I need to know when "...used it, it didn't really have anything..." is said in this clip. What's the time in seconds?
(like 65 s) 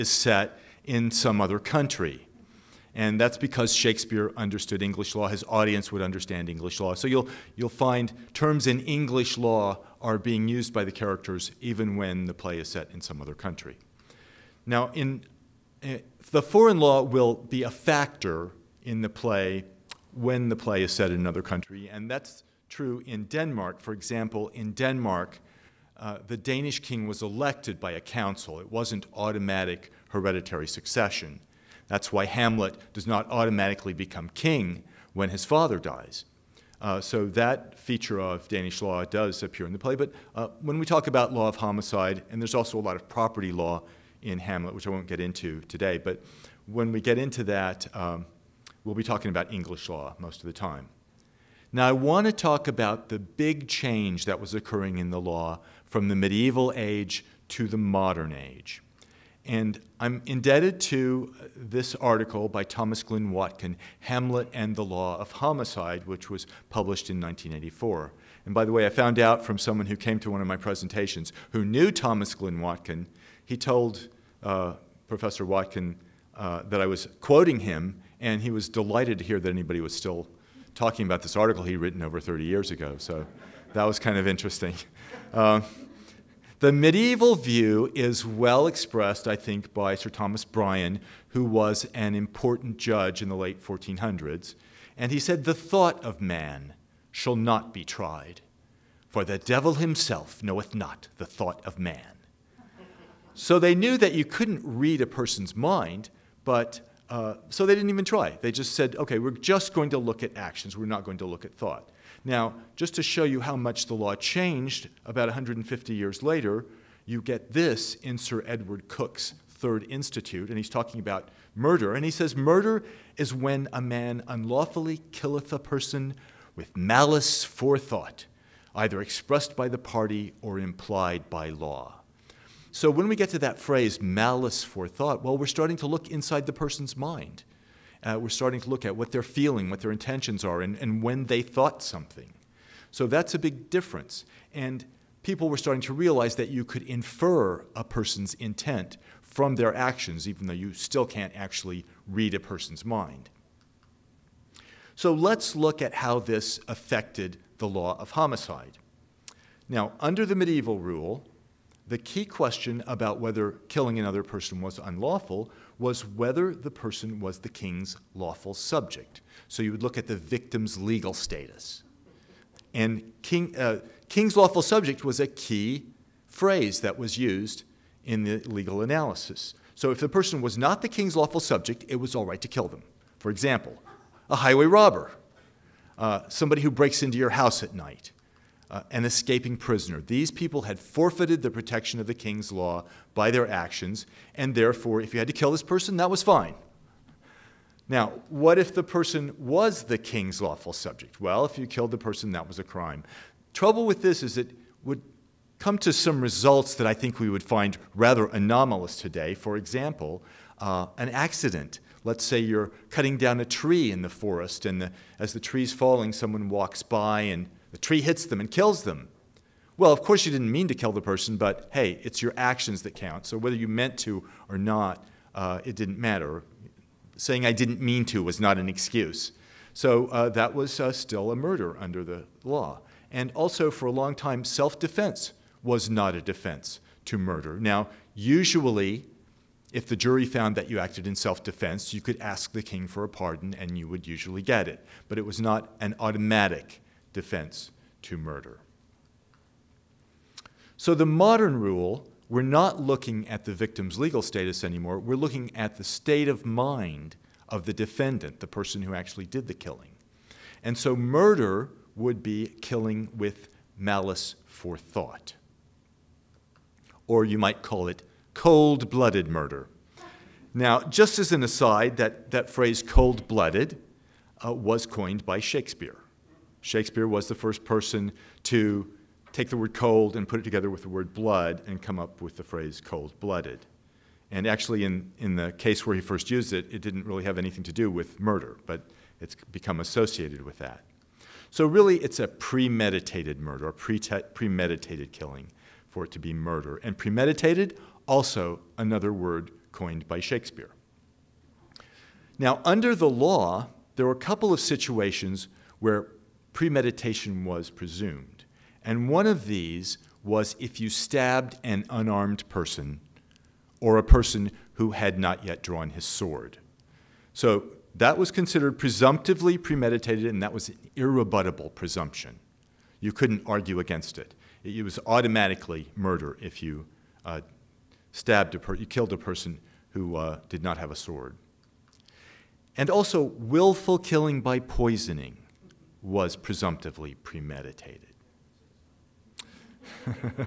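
286 s.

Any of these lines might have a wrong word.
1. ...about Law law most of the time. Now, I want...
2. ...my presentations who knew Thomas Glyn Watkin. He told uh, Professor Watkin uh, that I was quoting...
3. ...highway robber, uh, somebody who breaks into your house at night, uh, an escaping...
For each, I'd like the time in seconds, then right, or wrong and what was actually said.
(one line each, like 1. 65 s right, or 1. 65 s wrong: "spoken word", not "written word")
1. 49 s wrong: "English", not "Law"
2. 70 s right
3. 184 s right.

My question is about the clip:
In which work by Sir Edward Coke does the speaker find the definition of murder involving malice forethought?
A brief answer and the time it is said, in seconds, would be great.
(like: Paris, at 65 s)
Third Institute, at 119 s.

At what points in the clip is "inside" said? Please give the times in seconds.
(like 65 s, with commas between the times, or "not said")
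136 s.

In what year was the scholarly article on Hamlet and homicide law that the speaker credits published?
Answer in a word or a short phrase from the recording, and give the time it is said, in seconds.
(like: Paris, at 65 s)
1984, at 67 s.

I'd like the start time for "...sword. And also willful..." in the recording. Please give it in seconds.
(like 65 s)
330 s.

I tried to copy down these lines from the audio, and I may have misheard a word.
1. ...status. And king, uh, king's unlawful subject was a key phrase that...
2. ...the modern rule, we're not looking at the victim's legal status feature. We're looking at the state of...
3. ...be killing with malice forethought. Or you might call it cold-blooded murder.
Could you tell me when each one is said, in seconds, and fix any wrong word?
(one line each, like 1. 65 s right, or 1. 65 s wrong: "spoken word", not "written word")
1. 171 s wrong: "lawful", not "unlawful"
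2. 250 s wrong: "anymore", not "feature"
3. 262 s right.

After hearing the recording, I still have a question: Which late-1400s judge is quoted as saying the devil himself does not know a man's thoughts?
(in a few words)
Sir Thomas Bryan.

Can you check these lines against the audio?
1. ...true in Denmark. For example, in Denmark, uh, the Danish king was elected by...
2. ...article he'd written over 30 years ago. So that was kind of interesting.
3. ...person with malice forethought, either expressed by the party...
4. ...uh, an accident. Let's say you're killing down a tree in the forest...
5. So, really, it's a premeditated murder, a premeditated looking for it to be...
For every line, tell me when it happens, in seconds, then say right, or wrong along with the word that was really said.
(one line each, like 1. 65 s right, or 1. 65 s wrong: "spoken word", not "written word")
1. 22 s right
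2. 81 s right
3. 125 s right
4. 210 s wrong: "cutting", not "killing"
5. 291 s wrong: "killing", not "looking".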